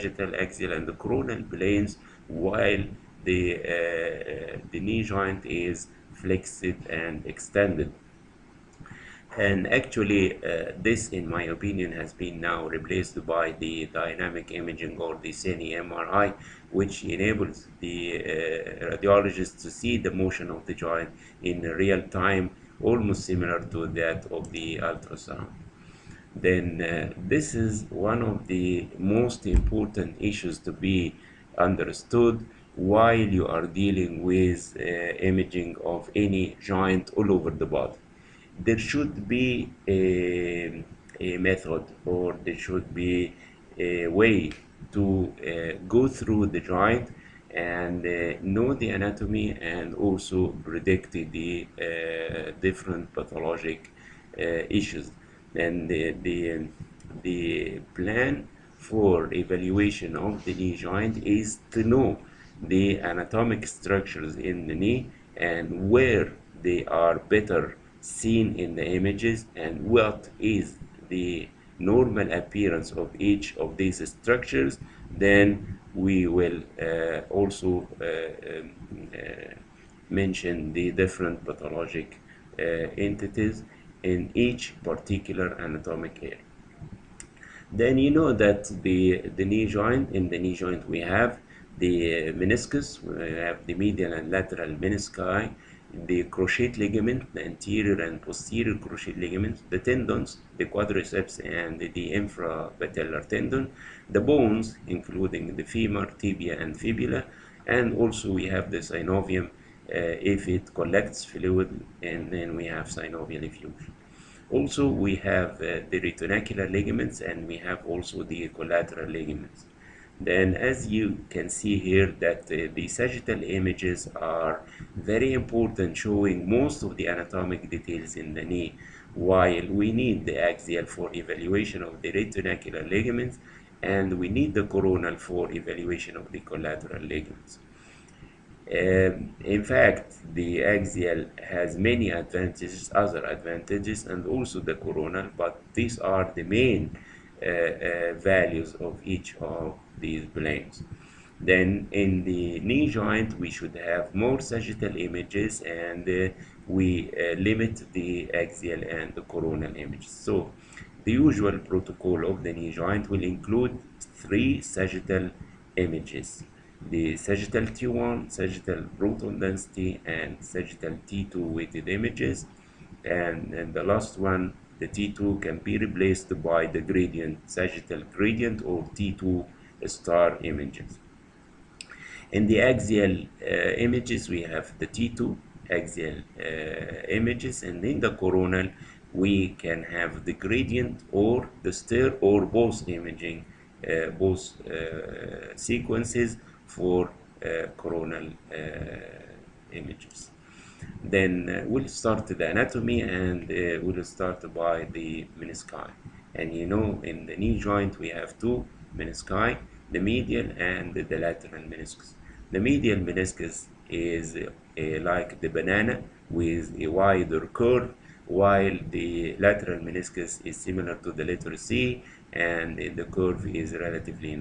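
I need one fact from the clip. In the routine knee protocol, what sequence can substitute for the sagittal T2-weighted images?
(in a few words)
gradient or T2 star.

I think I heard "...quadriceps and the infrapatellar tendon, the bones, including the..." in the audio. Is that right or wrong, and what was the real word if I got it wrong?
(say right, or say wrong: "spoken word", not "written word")
right.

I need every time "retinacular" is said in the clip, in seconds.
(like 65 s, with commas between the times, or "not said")
115 s, 132 s.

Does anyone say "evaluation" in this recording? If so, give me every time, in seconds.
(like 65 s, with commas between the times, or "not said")
59 s, 131 s, 135 s.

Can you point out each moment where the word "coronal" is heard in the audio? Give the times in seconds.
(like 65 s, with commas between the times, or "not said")
1 s, 134 s, 144 s, 159 s, 188 s, 197 s.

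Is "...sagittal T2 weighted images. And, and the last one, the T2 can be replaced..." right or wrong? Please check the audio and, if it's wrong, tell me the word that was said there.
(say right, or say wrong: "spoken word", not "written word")
right.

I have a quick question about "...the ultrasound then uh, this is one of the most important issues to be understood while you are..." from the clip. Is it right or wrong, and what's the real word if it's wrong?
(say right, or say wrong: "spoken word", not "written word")
right.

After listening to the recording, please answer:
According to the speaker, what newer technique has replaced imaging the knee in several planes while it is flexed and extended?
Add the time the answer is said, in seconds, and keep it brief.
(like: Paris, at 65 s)
cine MRI, at 15 s.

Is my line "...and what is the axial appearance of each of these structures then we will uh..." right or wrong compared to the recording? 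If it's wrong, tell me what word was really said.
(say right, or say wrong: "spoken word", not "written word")
wrong: "normal", not "axial".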